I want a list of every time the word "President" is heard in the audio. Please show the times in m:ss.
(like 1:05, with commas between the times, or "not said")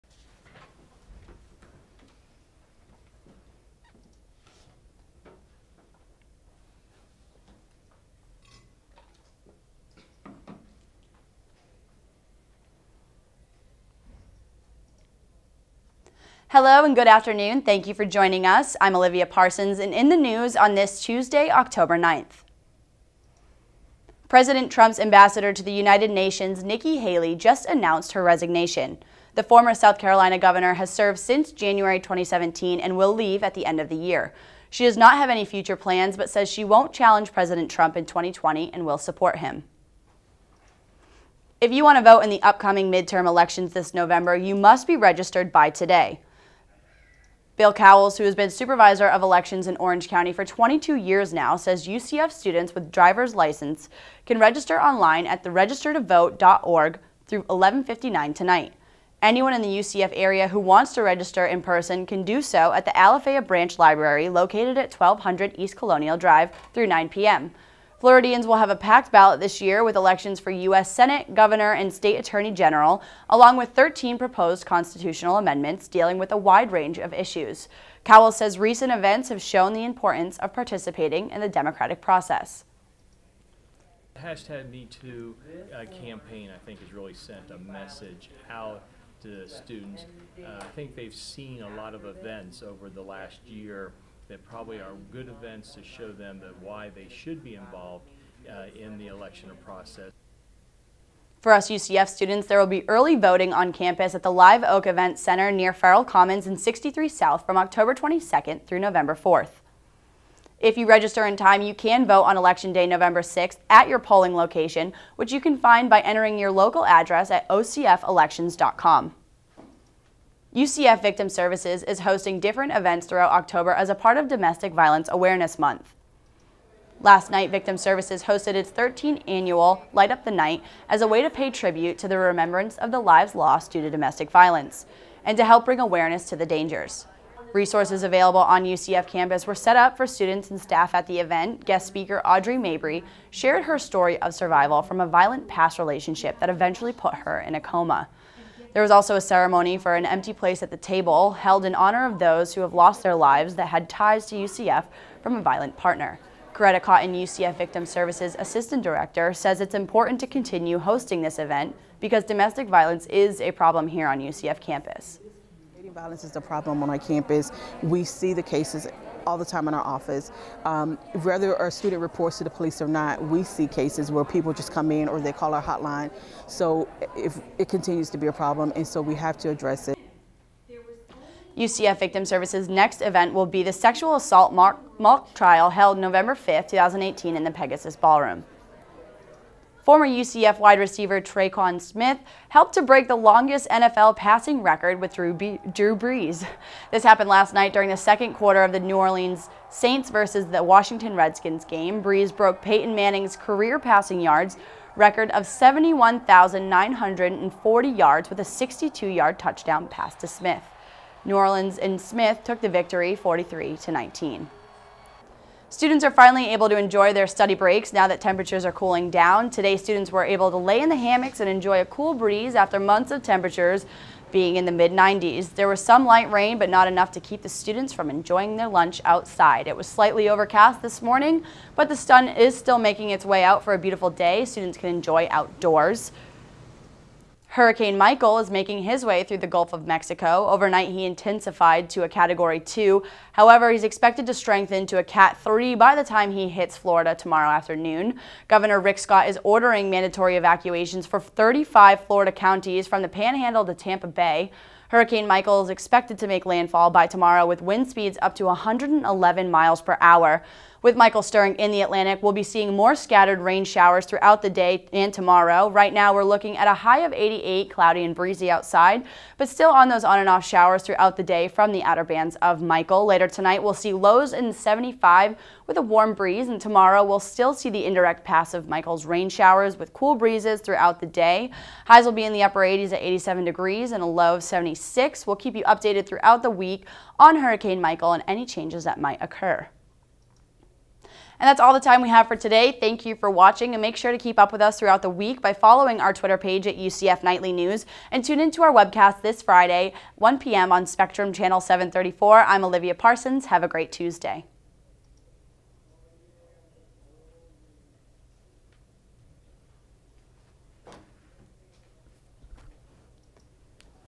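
0:24, 0:37.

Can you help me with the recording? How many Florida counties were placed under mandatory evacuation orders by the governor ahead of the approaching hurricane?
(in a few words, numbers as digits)
35.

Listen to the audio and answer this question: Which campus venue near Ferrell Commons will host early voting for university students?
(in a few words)
Live Oak Event Center.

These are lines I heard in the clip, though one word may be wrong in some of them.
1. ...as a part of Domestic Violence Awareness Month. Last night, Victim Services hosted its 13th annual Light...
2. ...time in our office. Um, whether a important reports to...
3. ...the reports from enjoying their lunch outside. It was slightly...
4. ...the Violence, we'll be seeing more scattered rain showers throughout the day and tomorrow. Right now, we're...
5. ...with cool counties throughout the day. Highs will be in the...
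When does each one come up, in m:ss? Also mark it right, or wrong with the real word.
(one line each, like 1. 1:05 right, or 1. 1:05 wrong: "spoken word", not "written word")
1. 2:03 right
2. 2:49 wrong: "student", not "important"
3. 3:47 wrong: "students", not "reports"
4. 4:21 wrong: "Atlantic", not "Violence"
5. 4:39 wrong: "breezes", not "counties".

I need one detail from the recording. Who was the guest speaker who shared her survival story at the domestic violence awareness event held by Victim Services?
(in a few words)
Audrey Mabrey.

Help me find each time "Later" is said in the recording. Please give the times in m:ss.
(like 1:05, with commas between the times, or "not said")
4:33.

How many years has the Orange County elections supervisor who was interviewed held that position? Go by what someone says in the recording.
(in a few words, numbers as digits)
22.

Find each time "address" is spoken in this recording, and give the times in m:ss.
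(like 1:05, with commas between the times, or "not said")
1:56, 2:59.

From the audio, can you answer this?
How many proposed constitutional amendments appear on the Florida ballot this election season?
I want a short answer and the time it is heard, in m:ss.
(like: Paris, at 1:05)
13, at 1:13.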